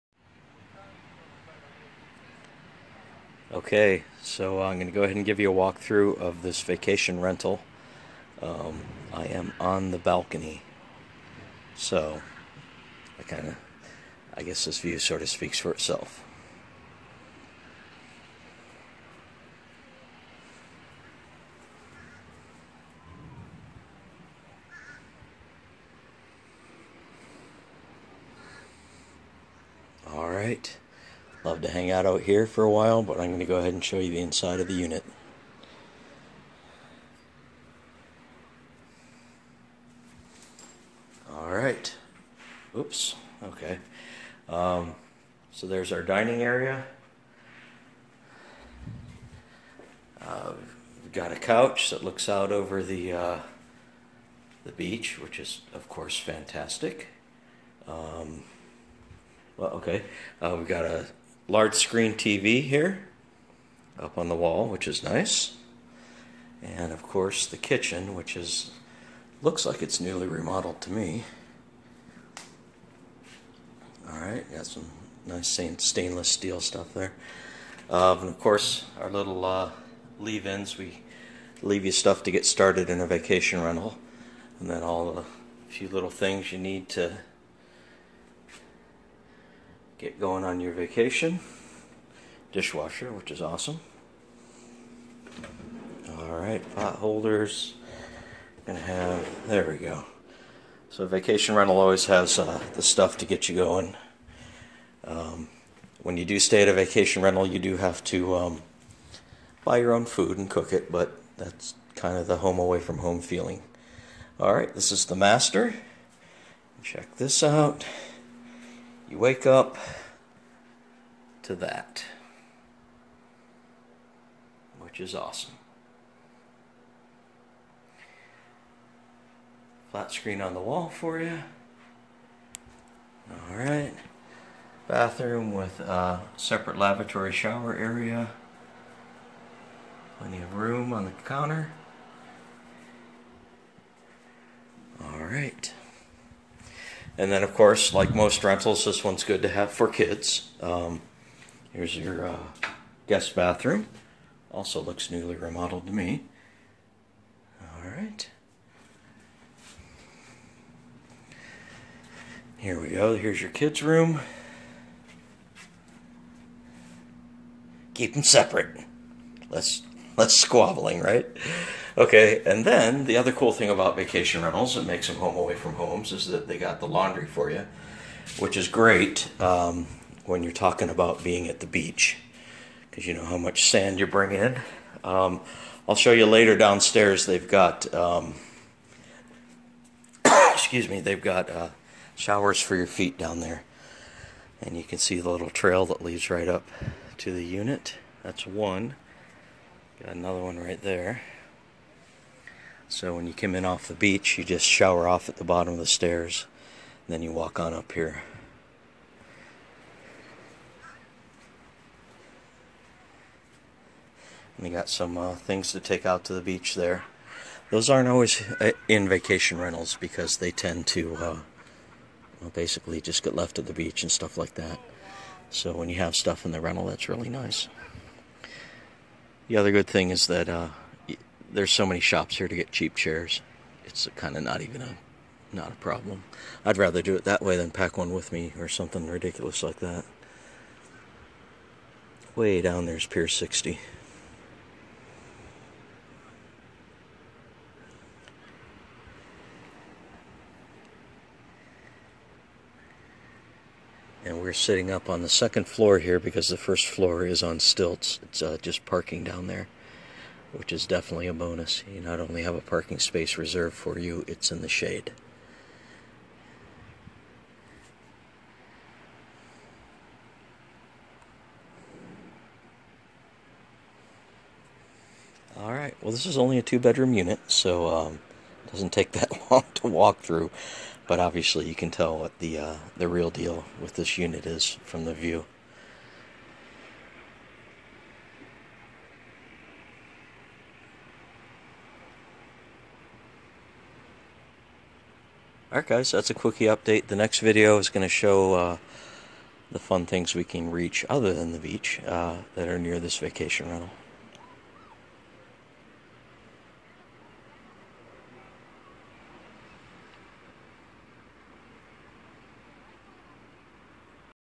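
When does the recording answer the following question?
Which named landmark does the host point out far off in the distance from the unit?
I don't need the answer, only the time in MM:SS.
04:03.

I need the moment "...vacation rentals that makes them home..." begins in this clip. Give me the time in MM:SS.
02:53.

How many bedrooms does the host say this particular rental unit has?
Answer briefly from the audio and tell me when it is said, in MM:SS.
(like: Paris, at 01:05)
2, at 04:36.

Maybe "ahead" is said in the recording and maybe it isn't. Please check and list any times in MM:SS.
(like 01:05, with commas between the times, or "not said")
00:05, 00:33.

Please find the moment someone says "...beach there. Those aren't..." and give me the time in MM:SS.
03:36.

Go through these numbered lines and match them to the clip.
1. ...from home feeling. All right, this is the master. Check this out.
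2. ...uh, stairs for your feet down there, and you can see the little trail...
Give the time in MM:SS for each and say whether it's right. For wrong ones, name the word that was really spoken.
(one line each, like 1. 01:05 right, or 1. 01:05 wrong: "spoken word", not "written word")
1. 01:52 right
2. 03:11 wrong: "showers", not "stairs".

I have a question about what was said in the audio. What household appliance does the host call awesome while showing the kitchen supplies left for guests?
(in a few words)
Dishwasher.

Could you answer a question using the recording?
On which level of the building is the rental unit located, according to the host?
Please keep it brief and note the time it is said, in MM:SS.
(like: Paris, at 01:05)
second floor, at 04:15.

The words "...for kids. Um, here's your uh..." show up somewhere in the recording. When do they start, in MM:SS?
02:29.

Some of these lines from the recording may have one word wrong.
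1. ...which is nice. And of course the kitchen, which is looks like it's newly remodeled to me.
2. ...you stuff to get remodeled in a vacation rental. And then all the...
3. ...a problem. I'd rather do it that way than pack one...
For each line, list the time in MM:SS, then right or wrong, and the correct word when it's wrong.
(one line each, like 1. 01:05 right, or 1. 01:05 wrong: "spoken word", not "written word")
1. 01:04 right
2. 01:21 wrong: "started", not "remodeled"
3. 03:55 right.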